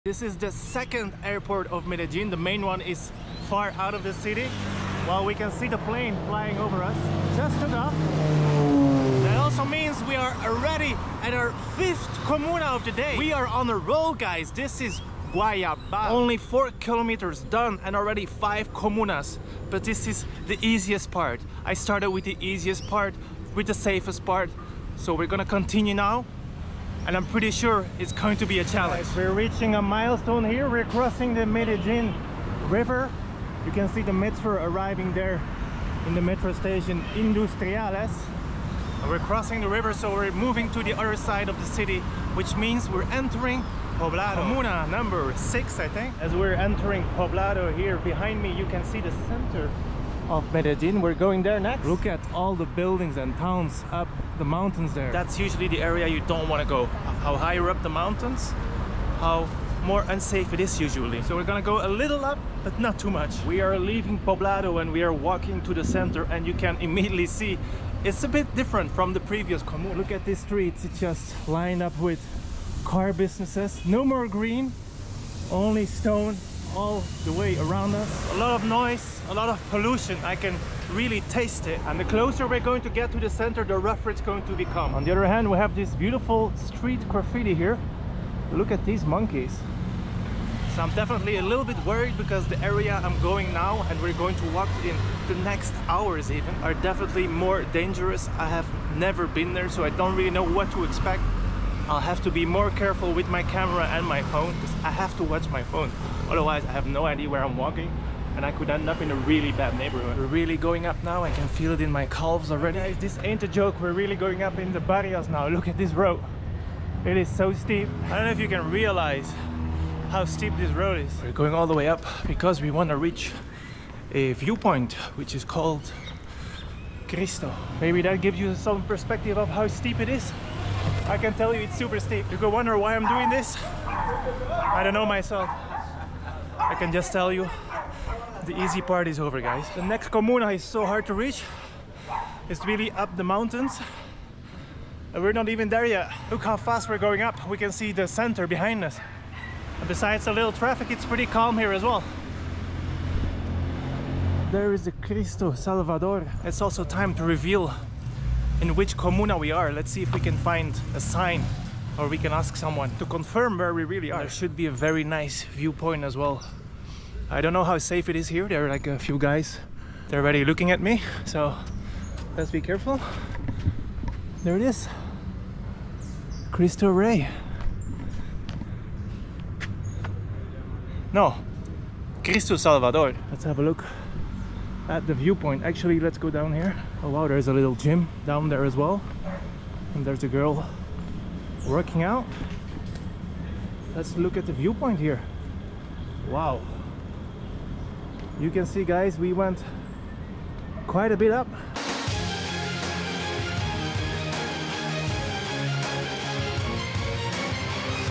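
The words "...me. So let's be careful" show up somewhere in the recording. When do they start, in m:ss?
2:50.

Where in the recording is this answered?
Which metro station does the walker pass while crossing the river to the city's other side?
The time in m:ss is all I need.
0:37.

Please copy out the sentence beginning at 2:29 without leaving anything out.
And besides a little traffic, it's pretty calm here as well.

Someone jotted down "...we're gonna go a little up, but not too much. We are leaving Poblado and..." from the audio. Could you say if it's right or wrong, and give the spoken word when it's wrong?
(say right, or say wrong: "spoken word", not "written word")
right.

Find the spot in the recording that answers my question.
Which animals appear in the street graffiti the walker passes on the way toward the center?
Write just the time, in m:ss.
1:29.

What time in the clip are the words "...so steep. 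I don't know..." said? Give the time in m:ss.
1:57.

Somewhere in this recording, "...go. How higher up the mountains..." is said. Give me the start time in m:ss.
0:56.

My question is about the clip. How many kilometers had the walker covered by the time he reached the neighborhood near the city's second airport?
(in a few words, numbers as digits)
4.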